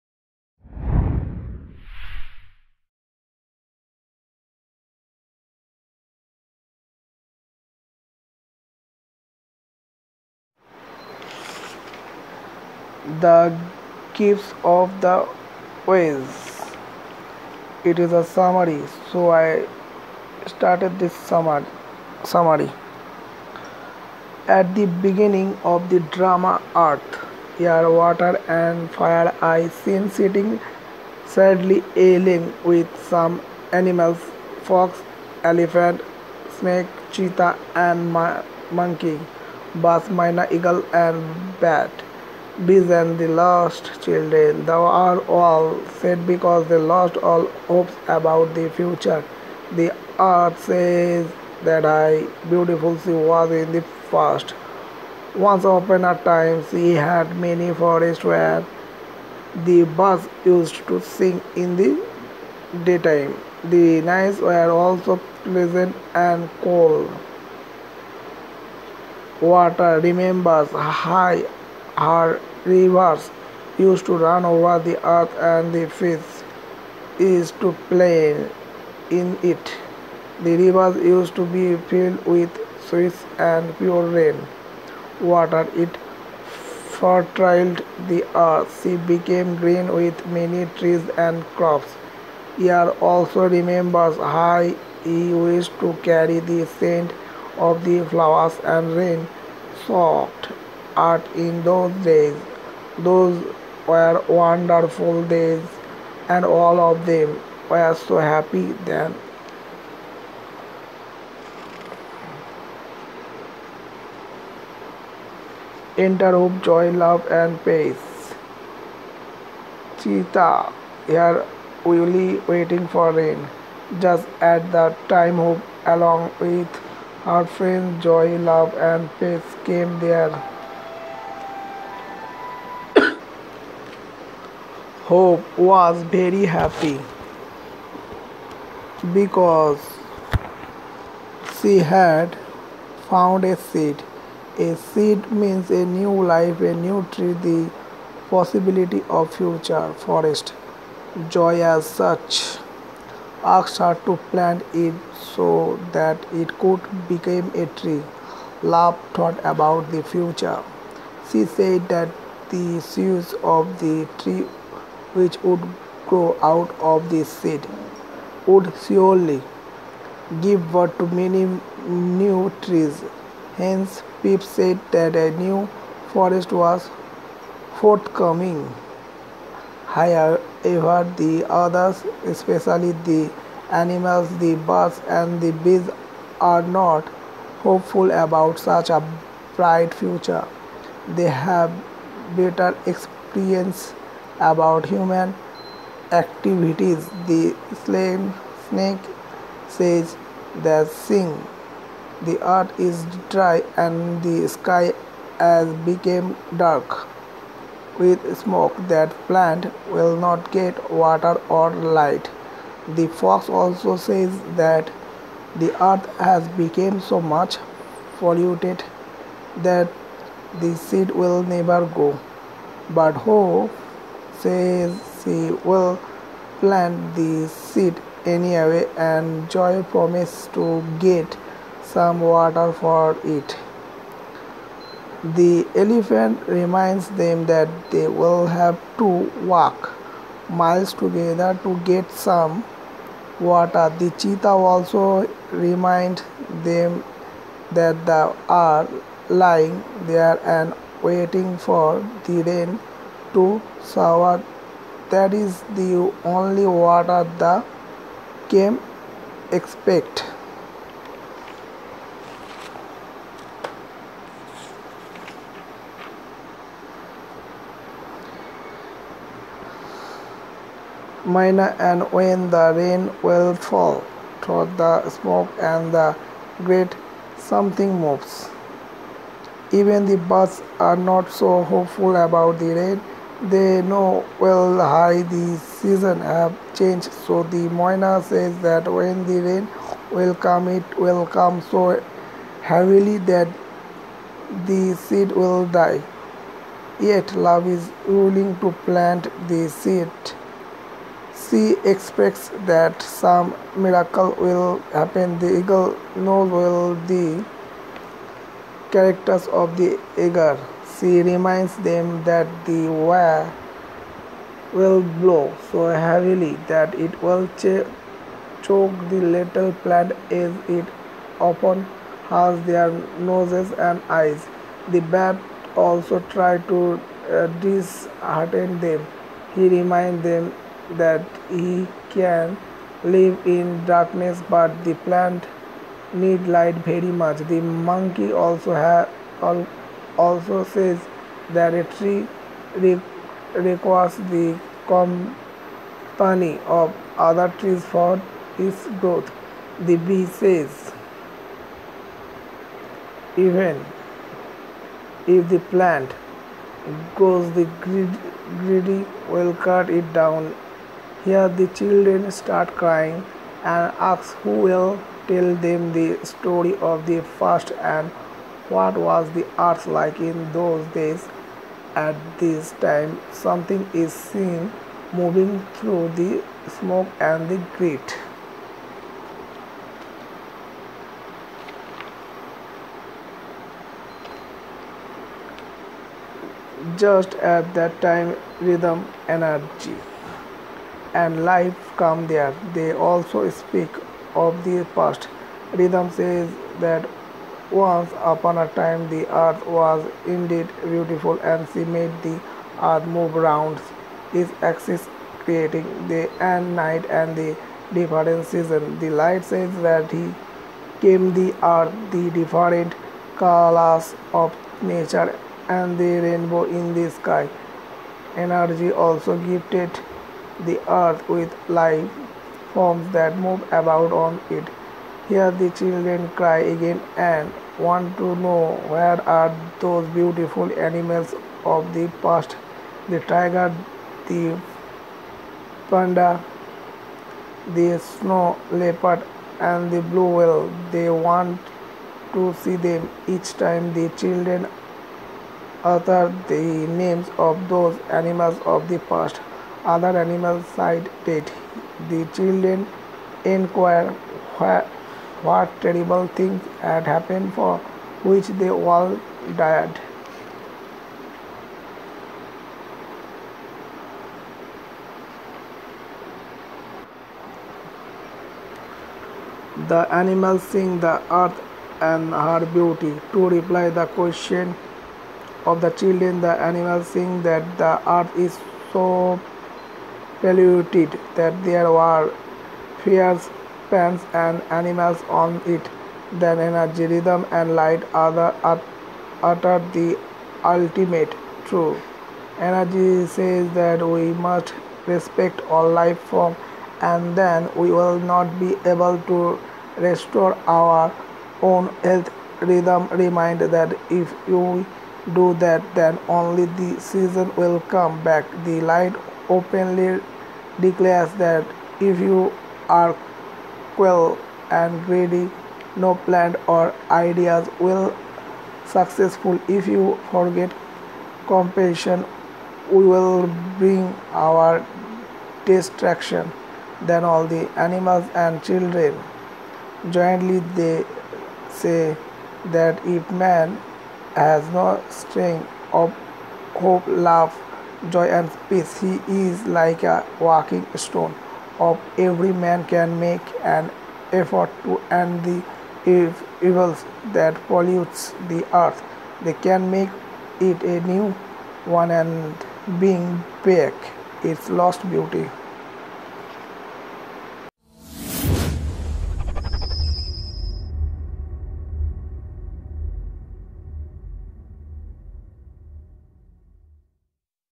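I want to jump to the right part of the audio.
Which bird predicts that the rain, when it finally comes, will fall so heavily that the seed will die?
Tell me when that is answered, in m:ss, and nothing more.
4:47.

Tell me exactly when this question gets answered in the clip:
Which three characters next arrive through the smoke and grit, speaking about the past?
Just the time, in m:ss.
6:28.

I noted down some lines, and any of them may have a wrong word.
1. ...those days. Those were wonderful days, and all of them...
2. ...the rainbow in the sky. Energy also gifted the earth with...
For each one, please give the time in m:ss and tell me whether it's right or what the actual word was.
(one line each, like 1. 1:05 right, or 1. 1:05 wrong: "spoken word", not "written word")
1. 1:41 right
2. 6:55 right.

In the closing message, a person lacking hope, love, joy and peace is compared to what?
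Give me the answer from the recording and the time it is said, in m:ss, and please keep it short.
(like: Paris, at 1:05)
a walking stone, at 9:00.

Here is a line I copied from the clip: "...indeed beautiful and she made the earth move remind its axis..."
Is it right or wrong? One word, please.
wrong.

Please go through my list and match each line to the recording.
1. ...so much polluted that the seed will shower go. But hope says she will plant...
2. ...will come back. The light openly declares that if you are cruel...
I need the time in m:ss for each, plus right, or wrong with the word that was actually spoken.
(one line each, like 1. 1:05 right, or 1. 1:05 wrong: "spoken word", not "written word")
1. 3:37 wrong: "never", not "shower"
2. 8:27 right.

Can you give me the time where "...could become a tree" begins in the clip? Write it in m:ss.
2:36.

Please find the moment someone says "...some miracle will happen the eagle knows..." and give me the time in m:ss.
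5:03.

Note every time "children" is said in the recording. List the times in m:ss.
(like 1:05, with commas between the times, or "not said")
0:44, 6:01, 7:05, 7:24, 7:32, 7:55, 8:48.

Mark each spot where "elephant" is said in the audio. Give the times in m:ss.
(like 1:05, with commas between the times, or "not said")
0:35, 3:55.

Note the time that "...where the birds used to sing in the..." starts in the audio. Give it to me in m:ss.
0:58.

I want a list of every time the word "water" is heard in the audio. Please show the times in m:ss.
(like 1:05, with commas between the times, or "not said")
0:27, 1:09, 1:25, 3:31, 3:52, 4:03, 4:16.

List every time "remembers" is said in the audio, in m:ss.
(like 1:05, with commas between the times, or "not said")
1:10, 1:33.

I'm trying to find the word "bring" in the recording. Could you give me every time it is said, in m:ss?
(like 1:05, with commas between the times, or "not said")
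8:43, 9:12.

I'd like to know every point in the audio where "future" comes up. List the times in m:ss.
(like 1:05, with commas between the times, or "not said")
0:48, 2:29, 2:40, 3:09.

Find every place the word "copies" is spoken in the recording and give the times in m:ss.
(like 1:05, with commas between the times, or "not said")
not said.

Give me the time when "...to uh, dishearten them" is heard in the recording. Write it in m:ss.
5:26.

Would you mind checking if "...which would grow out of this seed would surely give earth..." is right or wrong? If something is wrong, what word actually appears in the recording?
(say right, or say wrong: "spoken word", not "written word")
wrong: "birth", not "earth".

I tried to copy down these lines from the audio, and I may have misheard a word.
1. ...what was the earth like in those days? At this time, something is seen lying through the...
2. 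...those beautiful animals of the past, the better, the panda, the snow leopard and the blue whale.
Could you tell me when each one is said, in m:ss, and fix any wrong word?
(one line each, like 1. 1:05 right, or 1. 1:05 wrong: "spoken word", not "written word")
1. 6:08 wrong: "moving", not "lying"
2. 7:09 wrong: "tiger", not "better".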